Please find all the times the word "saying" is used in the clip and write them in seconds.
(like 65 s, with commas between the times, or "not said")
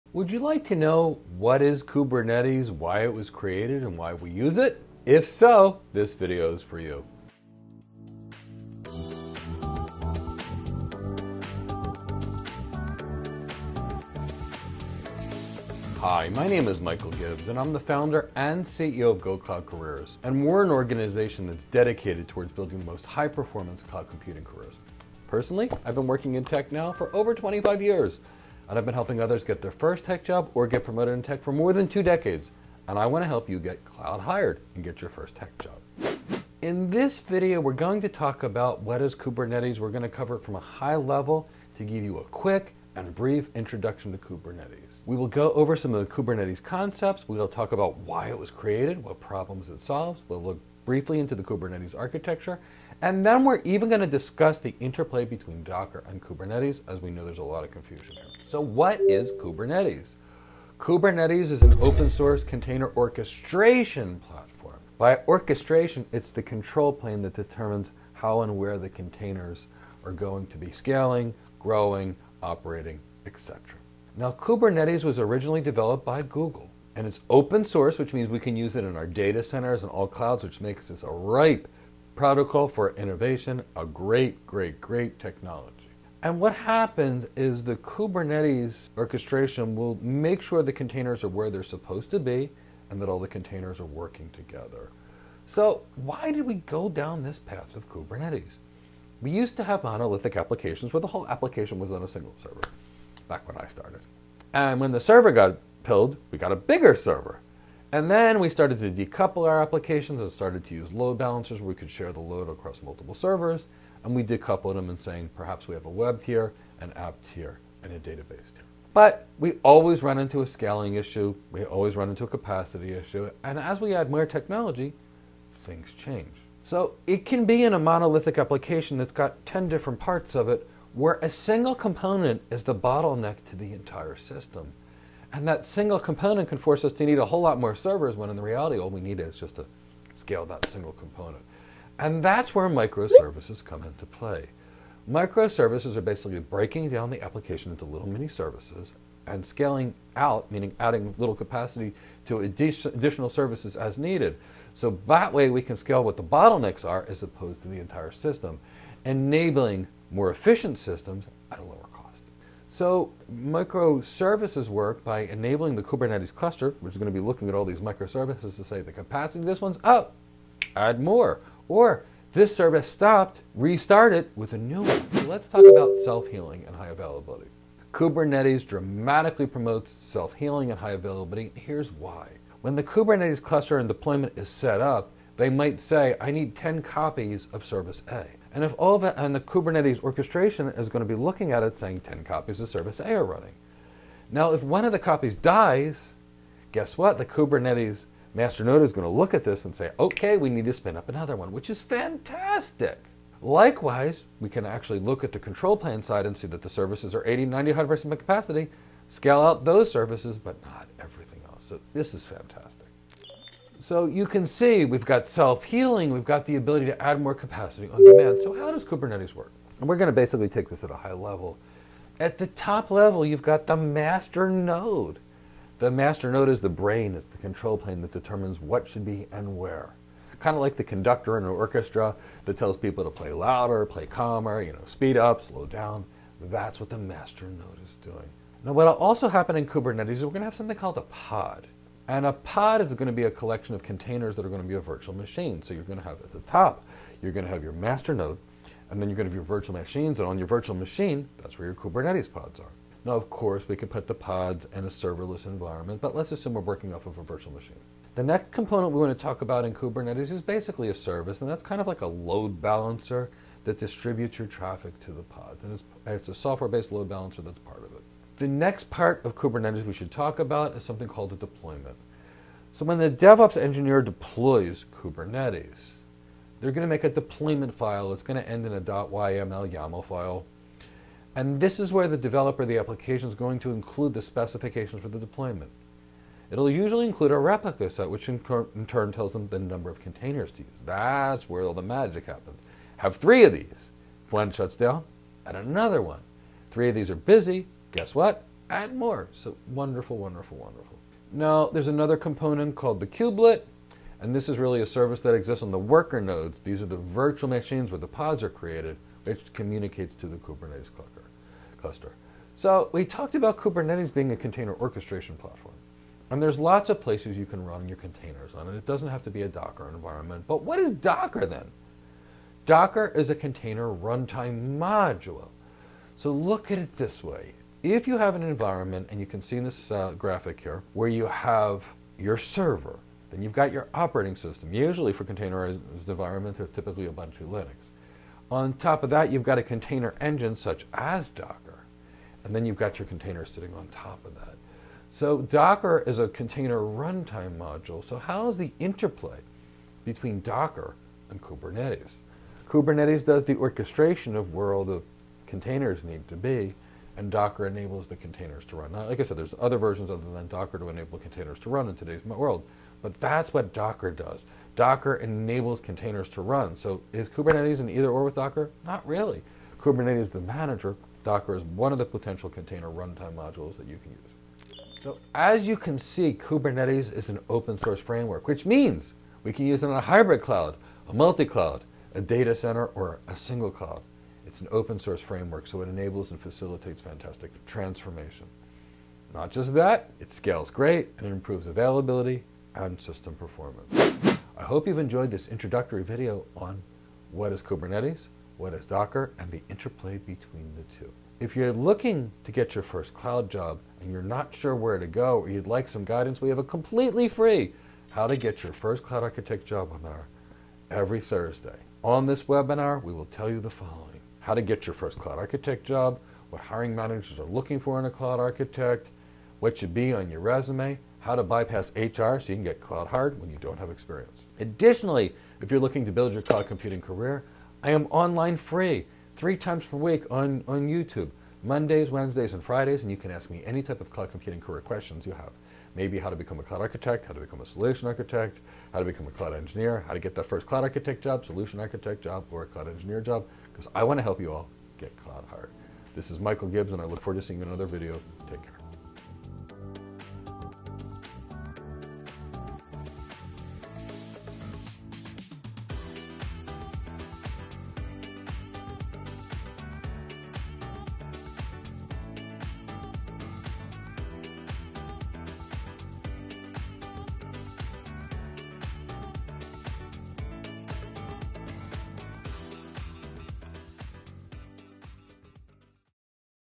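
114 s, 191 s.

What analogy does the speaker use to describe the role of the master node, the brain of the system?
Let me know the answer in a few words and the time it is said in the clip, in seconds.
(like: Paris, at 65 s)
the conductor in an orchestra, at 230 s.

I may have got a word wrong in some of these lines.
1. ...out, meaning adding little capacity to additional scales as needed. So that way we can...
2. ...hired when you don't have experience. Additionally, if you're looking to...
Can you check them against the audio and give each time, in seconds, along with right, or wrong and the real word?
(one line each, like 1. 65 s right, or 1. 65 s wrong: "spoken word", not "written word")
1. 150 s wrong: "services", not "scales"
2. 423 s right.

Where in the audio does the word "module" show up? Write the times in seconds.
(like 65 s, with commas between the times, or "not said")
324 s, 347 s, 373 s.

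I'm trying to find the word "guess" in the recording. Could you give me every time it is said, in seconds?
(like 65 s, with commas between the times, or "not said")
196 s, 297 s.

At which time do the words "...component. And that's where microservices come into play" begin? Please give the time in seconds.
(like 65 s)
140 s.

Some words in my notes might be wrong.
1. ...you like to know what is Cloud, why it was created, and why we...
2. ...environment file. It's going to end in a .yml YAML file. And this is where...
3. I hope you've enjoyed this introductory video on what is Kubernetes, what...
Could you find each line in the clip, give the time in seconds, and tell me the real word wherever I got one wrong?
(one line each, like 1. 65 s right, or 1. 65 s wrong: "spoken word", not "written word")
1. 0 s wrong: "Kubernetes", not "Cloud"
2. 277 s wrong: "deployment", not "environment"
3. 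394 s right.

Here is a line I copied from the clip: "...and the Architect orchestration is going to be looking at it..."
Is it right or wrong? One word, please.
wrong.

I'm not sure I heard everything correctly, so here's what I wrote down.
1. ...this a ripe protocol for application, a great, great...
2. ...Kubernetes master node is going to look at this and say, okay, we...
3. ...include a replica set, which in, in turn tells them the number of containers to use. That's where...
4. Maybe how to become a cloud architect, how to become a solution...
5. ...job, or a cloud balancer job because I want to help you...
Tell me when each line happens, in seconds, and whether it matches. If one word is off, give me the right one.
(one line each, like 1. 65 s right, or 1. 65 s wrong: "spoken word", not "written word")
1. 80 s wrong: "innovation", not "application"
2. 197 s right
3. 287 s right
4. 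435 s right
5. 442 s wrong: "engineer", not "balancer".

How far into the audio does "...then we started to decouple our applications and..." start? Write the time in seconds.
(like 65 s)
108 s.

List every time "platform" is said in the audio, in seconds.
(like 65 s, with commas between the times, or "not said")
64 s, 315 s.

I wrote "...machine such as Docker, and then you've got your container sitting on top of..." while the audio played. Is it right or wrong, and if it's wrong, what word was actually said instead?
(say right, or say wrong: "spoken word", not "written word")
wrong: "engine", not "machine".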